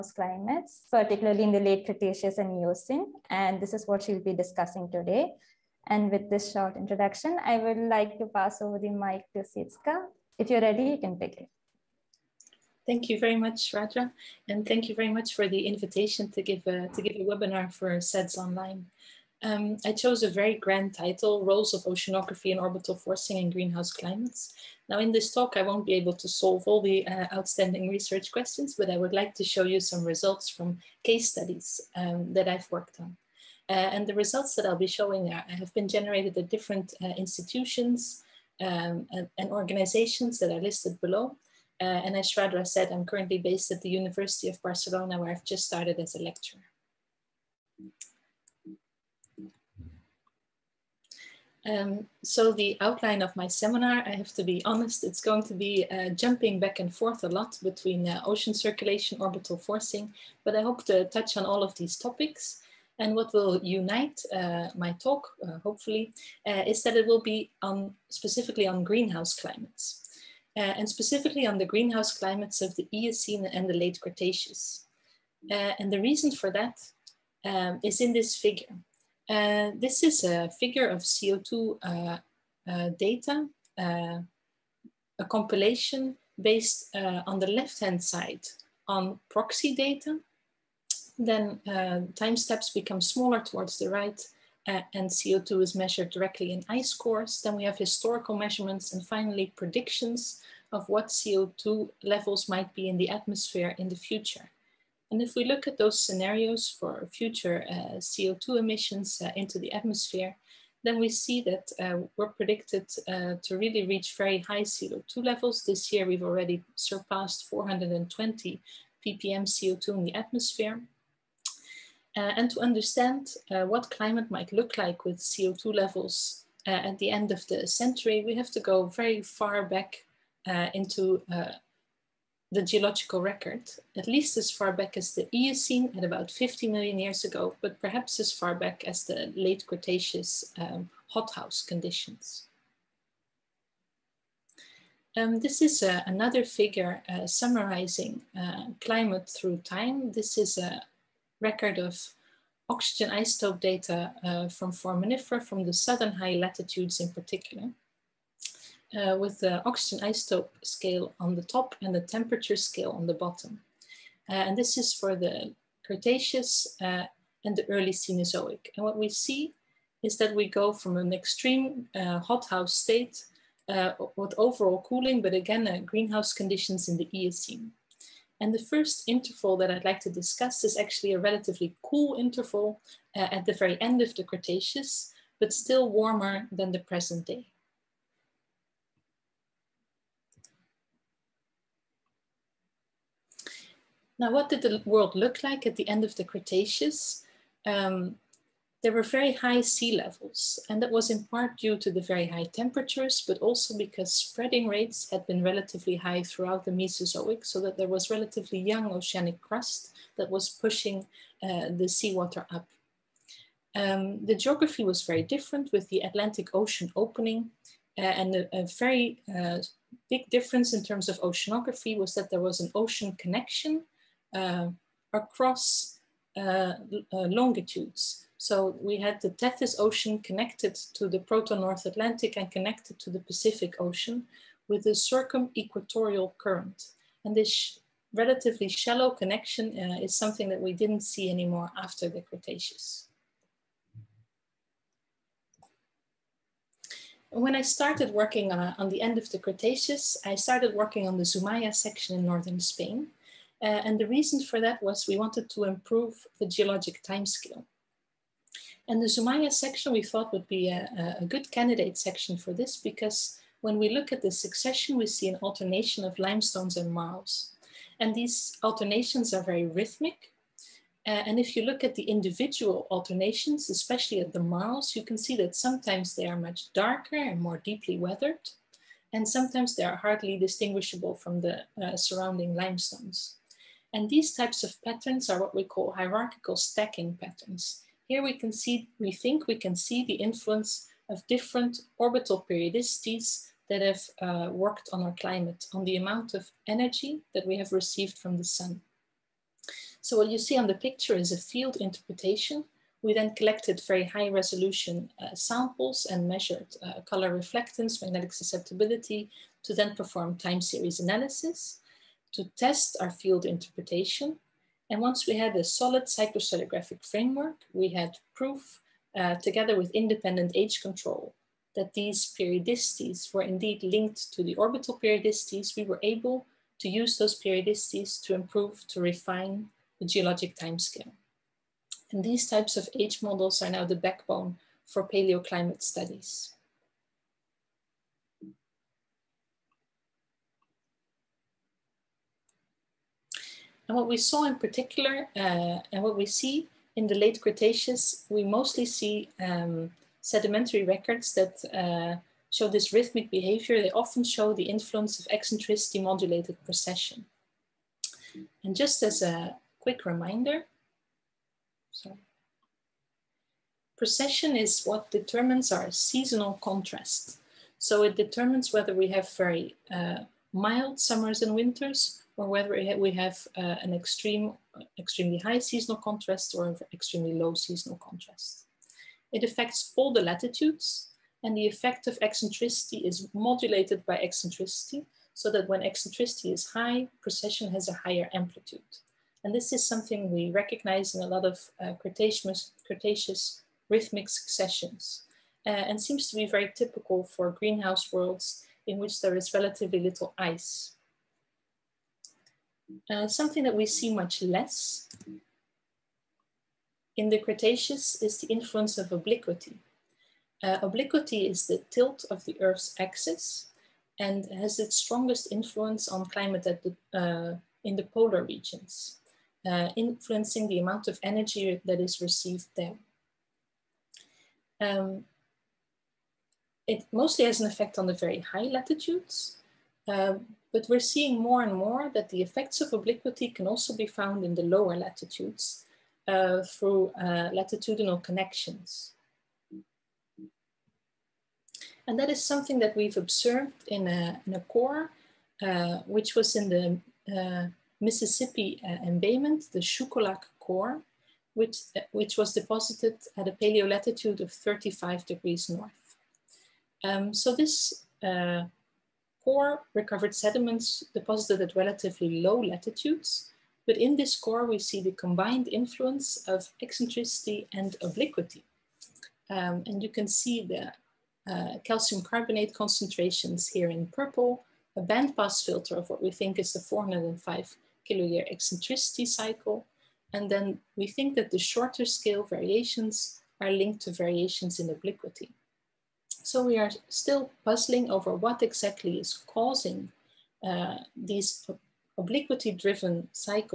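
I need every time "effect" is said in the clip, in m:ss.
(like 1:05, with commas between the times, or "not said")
6:21, 7:07, 7:12.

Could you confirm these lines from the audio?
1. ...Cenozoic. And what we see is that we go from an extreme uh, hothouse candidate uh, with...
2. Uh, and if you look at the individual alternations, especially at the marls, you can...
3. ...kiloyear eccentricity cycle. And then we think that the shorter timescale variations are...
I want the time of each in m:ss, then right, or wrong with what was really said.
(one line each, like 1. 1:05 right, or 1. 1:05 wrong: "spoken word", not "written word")
1. 2:47 wrong: "state", not "candidate"
2. 4:31 right
3. 7:58 wrong: "scale", not "timescale".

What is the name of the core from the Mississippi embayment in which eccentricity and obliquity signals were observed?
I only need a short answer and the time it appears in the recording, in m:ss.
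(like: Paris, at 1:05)
Shuqualak core, at 7:29.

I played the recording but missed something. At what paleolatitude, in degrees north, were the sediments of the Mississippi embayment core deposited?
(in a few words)
35 degrees north.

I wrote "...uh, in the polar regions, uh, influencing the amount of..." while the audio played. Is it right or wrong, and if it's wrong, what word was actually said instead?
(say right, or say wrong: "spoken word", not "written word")
right.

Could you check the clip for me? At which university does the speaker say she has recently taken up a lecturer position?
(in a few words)
University of Barcelona.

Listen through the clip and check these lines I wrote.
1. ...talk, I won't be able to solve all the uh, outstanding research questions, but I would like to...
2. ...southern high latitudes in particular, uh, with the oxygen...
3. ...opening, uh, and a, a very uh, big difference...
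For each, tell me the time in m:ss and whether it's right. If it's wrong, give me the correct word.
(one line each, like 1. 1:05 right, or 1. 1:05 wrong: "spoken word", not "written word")
1. 0:25 right
2. 2:35 right
3. 3:36 right.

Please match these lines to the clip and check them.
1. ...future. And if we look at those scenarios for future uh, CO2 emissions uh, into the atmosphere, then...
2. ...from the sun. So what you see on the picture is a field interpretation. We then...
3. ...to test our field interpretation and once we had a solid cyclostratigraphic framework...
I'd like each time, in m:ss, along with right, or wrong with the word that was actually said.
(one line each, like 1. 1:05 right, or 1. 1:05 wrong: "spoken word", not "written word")
1. 1:43 right
2. 4:58 right
3. 5:12 right.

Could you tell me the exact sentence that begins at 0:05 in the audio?
And with this short introduction, I would like to pass over the mic to Sietske.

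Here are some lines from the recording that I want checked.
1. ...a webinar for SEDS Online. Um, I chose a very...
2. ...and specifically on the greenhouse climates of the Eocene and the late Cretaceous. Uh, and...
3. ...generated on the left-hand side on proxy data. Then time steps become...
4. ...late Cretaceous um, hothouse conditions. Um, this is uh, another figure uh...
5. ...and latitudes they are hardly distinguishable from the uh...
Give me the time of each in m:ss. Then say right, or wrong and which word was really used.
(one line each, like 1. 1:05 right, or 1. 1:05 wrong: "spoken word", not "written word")
1. 0:17 right
2. 1:10 right
3. 1:26 wrong: "based", not "generated"
4. 2:19 right
5. 4:39 wrong: "sometimes", not "latitudes".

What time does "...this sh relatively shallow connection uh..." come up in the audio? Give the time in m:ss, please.
3:57.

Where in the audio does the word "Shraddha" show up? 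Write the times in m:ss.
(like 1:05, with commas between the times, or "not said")
0:42.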